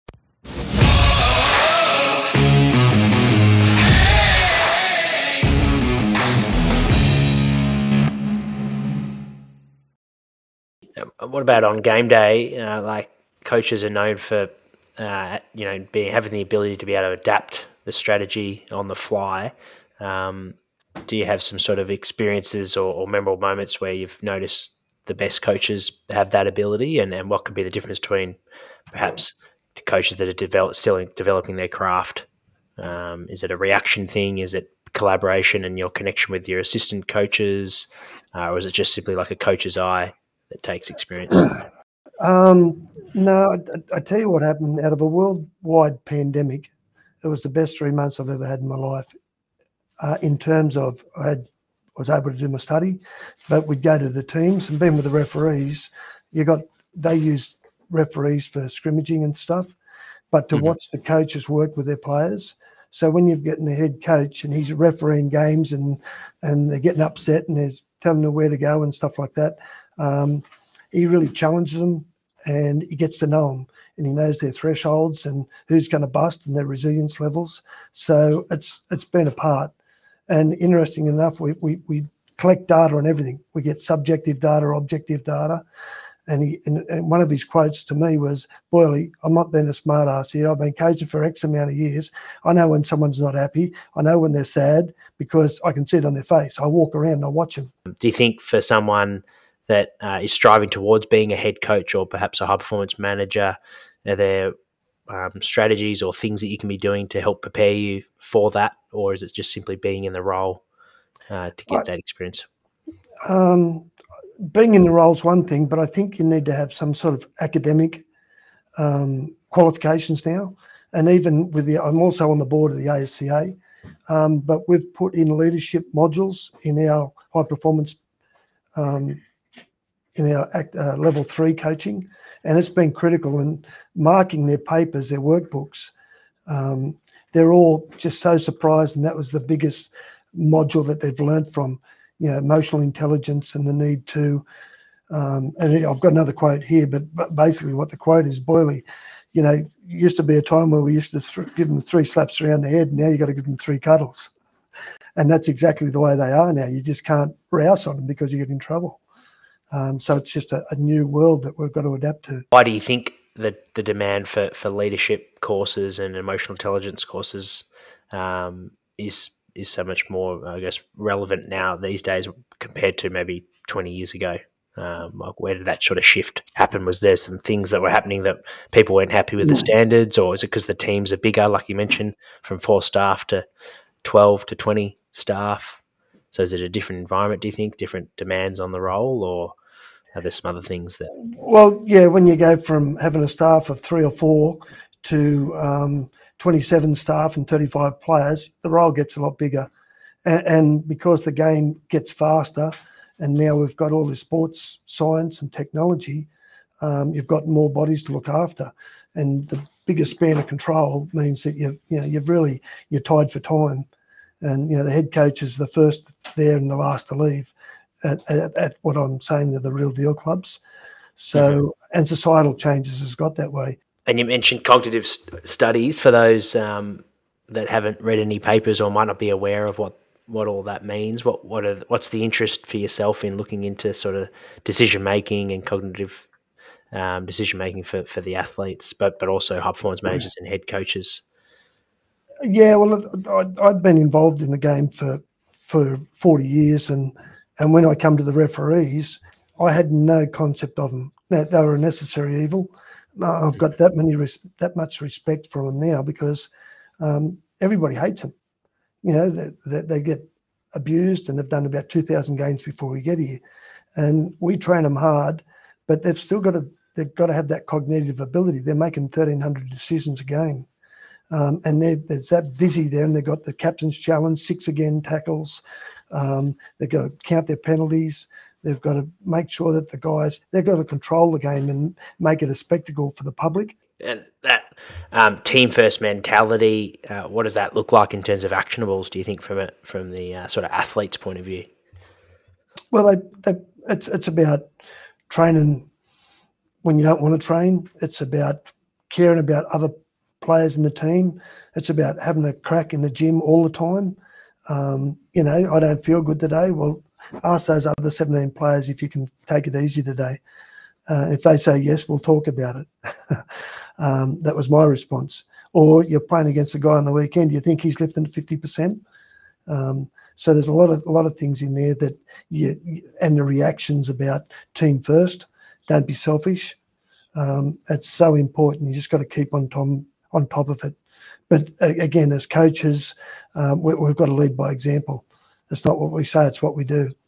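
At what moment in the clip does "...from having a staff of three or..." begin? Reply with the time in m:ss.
3:12.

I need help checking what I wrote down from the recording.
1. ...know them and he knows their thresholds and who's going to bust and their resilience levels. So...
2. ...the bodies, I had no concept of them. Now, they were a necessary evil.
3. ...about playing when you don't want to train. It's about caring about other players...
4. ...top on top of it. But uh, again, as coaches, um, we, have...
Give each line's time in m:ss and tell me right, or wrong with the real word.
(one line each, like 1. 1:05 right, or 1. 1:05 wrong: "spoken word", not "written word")
1. 1:13 right
2. 4:08 wrong: "referees", not "bodies"
3. 4:54 wrong: "training", not "playing"
4. 5:29 right.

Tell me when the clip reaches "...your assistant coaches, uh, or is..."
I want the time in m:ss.
0:36.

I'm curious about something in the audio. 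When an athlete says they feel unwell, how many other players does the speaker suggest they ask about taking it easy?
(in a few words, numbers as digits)
17.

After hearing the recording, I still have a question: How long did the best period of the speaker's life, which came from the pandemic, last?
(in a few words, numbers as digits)
3 months.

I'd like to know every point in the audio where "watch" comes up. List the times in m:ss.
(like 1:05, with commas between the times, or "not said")
1:00, 1:37.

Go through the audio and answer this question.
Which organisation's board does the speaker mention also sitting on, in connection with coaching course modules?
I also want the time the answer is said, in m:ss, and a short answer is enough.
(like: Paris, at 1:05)
ASCA, at 2:02.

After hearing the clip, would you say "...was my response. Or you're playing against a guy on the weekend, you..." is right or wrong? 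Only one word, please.
right.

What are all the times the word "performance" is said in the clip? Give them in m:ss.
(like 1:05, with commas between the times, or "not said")
1:42, 2:07, 3:59.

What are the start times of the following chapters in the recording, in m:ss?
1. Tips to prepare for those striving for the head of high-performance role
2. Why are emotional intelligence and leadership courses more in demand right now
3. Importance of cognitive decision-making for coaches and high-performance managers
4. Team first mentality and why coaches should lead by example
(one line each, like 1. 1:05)
1. 1:37
2. 2:42
3. 3:43
4. 4:43.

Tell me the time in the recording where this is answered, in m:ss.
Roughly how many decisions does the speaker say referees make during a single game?
4:29.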